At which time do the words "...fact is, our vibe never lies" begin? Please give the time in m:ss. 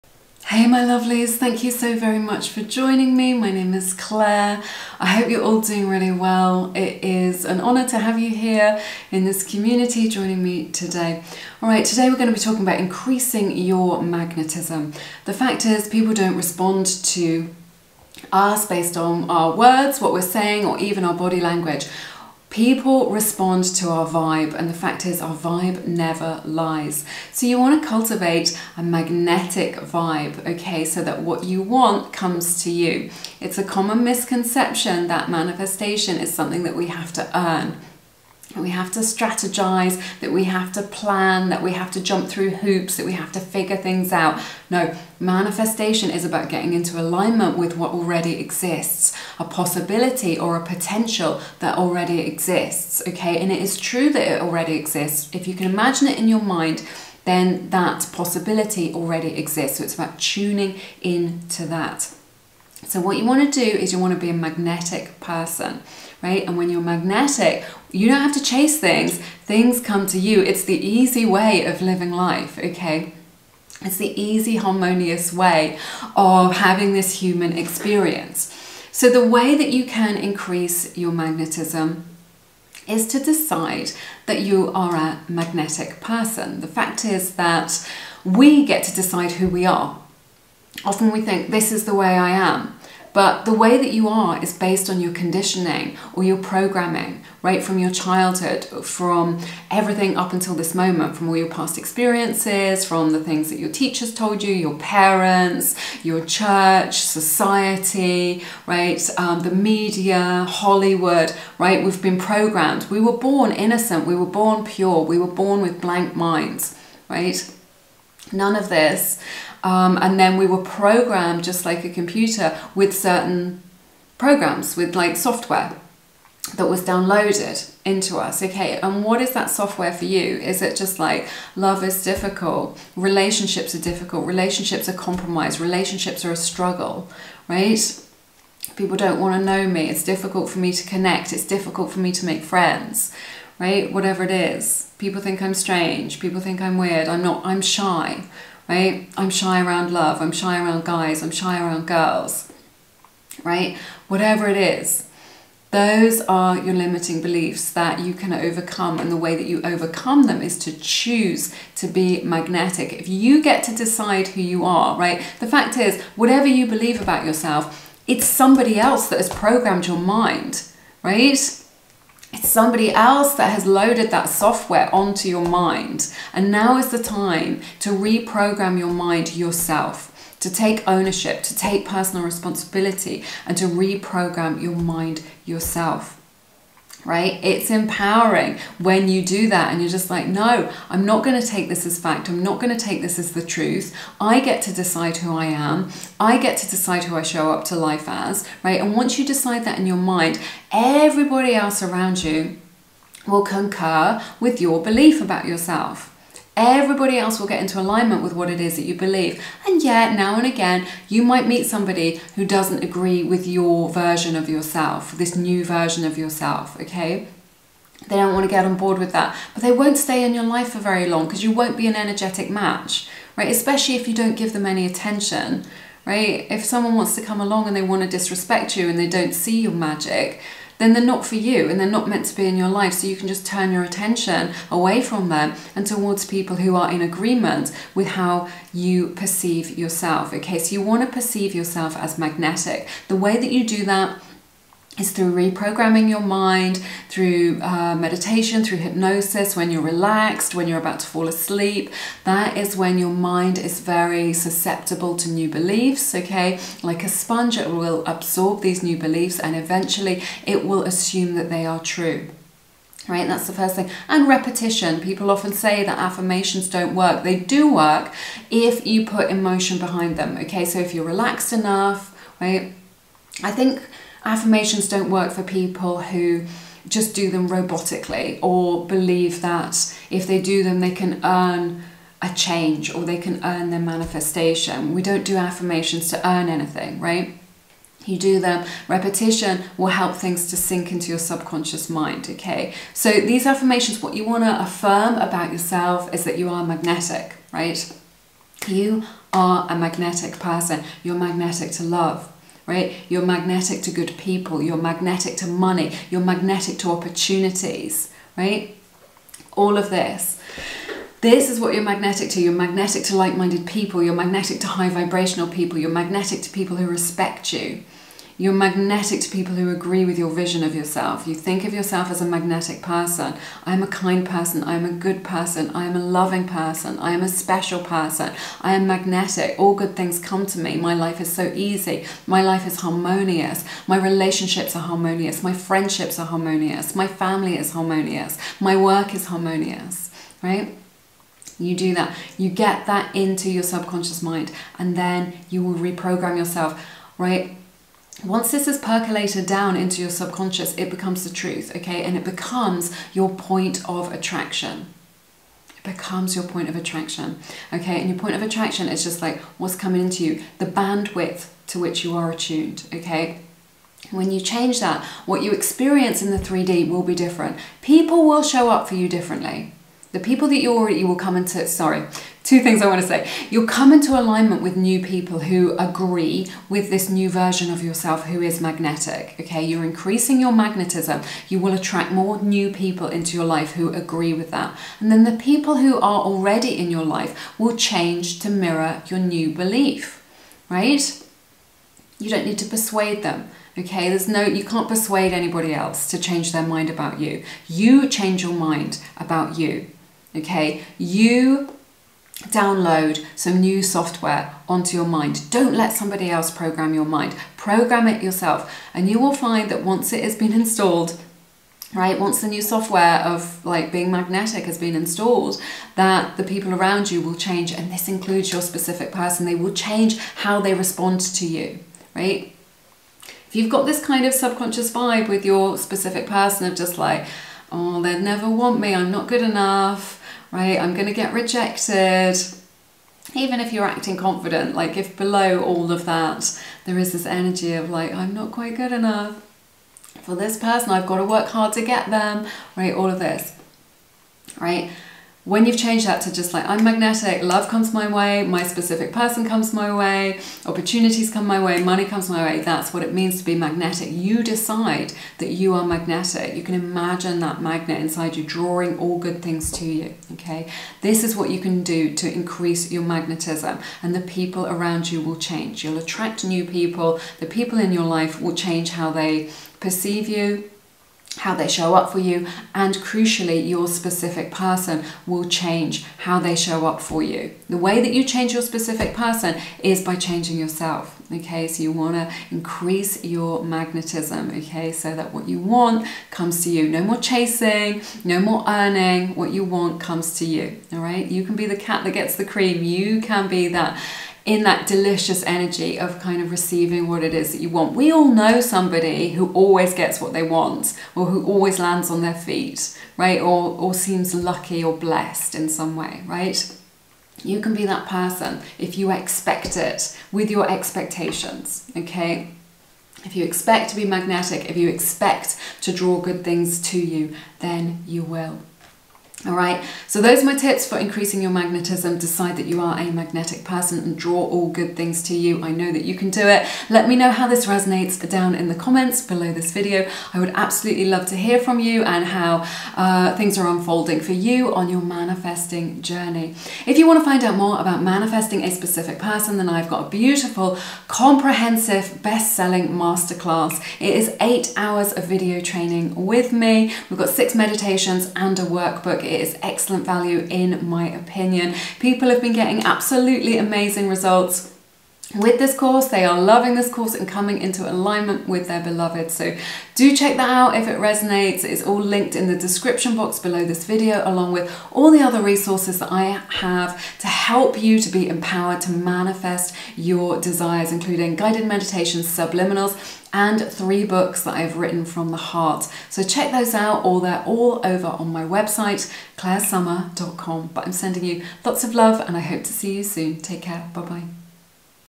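0:24.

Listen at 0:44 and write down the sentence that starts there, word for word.
No, manifestation is about getting into alignment with what already exists, a possibility or a potential that already exists, okay?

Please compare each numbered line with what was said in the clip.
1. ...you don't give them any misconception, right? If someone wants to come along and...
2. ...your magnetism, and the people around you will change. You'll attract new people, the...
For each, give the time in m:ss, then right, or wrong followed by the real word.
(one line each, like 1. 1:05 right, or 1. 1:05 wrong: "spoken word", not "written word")
1. 3:44 wrong: "attention", not "misconception"
2. 7:42 right.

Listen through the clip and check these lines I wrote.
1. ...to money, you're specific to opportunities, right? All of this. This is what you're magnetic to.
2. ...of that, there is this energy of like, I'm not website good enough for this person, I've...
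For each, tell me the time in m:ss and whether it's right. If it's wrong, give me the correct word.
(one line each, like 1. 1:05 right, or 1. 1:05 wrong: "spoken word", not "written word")
1. 5:05 wrong: "magnetic", not "specific"
2. 7:15 wrong: "quite", not "website".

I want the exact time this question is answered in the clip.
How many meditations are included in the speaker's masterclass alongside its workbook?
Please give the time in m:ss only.
9:07.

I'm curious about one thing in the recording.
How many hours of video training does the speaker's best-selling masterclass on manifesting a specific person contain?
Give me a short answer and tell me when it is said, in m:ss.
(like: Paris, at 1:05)
8, at 9:04.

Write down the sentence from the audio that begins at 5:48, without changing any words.
once this is percolated down into your subconscious, it becomes the truth, okay?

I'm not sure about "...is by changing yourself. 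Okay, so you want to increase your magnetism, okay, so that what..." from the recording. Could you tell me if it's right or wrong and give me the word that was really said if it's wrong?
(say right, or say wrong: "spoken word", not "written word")
right.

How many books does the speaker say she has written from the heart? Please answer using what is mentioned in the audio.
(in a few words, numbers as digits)
3.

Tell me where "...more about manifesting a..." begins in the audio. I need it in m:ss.
8:57.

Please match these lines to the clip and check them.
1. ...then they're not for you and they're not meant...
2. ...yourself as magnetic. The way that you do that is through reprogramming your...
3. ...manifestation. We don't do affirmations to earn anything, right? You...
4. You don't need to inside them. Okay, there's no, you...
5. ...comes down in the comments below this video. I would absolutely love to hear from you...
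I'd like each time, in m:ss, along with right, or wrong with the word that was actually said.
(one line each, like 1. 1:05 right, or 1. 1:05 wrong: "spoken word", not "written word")
1. 3:50 right
2. 4:01 right
3. 4:43 right
4. 6:32 wrong: "persuade", not "inside"
5. 8:47 wrong: "resonates", not "comes".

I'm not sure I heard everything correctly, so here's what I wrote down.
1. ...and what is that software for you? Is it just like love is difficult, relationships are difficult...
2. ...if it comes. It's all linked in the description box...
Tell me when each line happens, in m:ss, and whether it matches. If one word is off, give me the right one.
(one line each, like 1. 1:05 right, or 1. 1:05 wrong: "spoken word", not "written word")
1. 2:08 right
2. 9:20 wrong: "resonates", not "comes".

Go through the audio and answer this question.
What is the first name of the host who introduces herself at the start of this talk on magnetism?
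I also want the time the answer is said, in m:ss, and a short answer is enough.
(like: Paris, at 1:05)
Clair, at 0:03.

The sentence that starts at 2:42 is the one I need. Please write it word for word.
If you get to decide who you are, right?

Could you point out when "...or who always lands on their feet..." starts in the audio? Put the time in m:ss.
8:21.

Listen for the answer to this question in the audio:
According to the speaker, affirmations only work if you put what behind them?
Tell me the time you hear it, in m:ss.
4:29.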